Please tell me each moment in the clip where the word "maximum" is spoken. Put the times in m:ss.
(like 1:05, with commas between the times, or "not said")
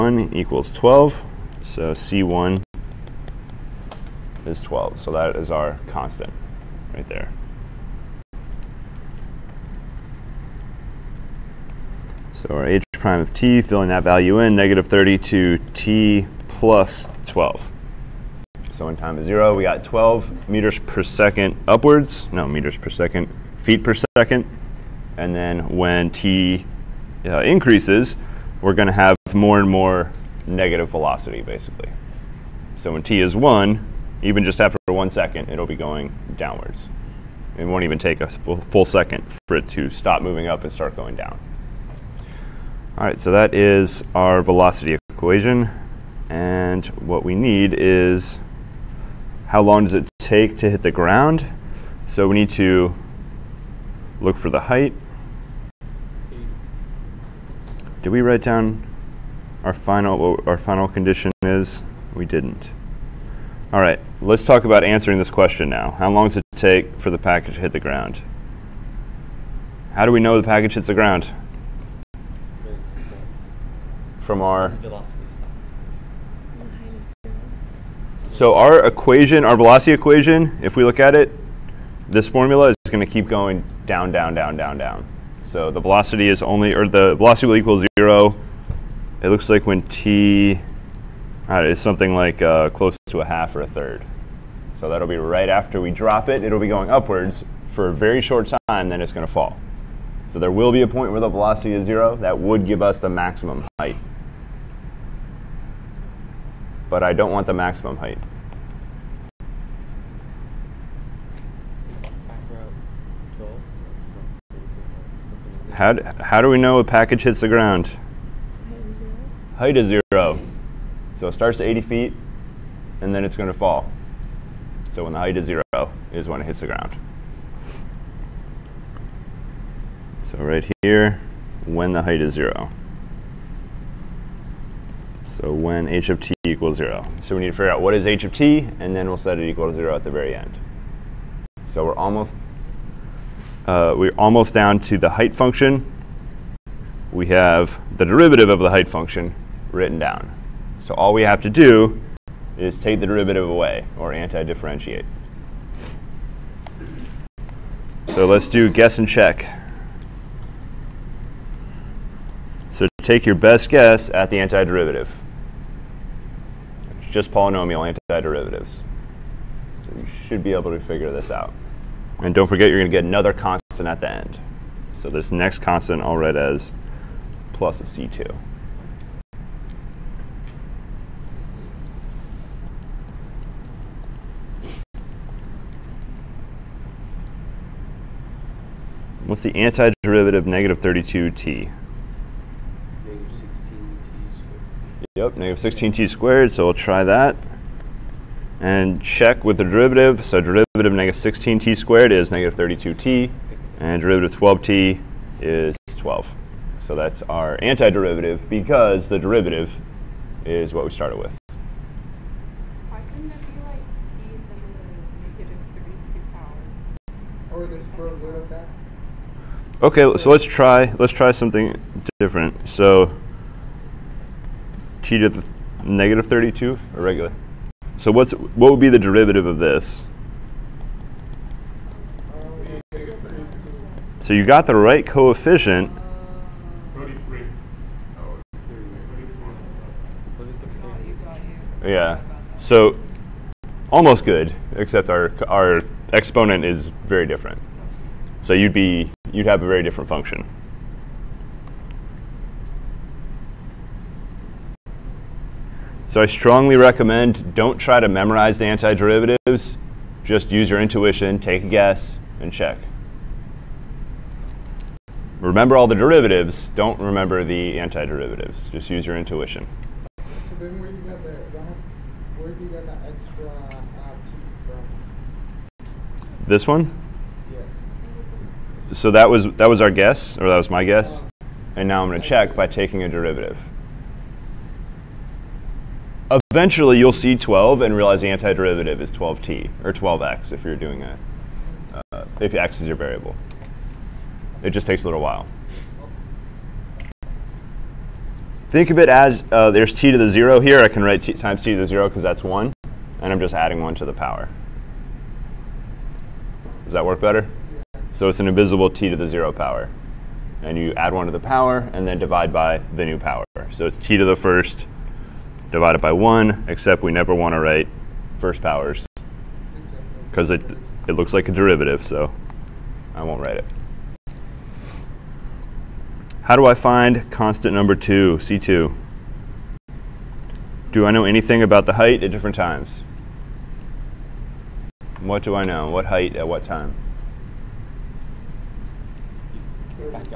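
1:43, 1:47.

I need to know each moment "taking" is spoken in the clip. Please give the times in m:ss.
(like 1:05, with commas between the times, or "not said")
4:42.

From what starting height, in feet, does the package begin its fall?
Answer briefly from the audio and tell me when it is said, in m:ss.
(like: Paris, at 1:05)
80 feet, at 2:01.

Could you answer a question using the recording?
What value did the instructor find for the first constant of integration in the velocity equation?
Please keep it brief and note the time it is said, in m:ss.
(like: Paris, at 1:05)
12, at 0:01.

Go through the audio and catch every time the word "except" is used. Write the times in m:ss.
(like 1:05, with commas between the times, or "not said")
4:04, 5:16.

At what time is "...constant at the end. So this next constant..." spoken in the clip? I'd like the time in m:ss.
2:53.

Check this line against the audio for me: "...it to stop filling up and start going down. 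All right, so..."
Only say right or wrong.
wrong.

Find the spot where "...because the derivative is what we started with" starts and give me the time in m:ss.
3:28.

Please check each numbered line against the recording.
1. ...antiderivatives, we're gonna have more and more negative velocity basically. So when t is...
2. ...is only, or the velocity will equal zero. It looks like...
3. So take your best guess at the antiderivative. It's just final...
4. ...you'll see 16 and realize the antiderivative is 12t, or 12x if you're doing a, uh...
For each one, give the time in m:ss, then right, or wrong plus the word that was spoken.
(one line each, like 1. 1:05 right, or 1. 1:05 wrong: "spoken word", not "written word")
1. 0:27 wrong: "increases", not "antiderivatives"
2. 1:26 right
3. 2:42 wrong: "polynomial", not "final"
4. 4:46 wrong: "12", not "16".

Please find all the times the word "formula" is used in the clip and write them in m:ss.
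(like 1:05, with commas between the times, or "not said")
1:22.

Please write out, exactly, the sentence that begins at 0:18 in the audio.
So in time is zero, we got 12 meters per second upwards, no meters per second, feet per second.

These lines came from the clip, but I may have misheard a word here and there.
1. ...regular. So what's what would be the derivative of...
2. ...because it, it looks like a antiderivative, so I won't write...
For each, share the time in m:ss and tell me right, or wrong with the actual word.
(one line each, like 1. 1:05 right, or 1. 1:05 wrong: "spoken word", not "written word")
1. 3:47 right
2. 5:20 wrong: "derivative", not "antiderivative".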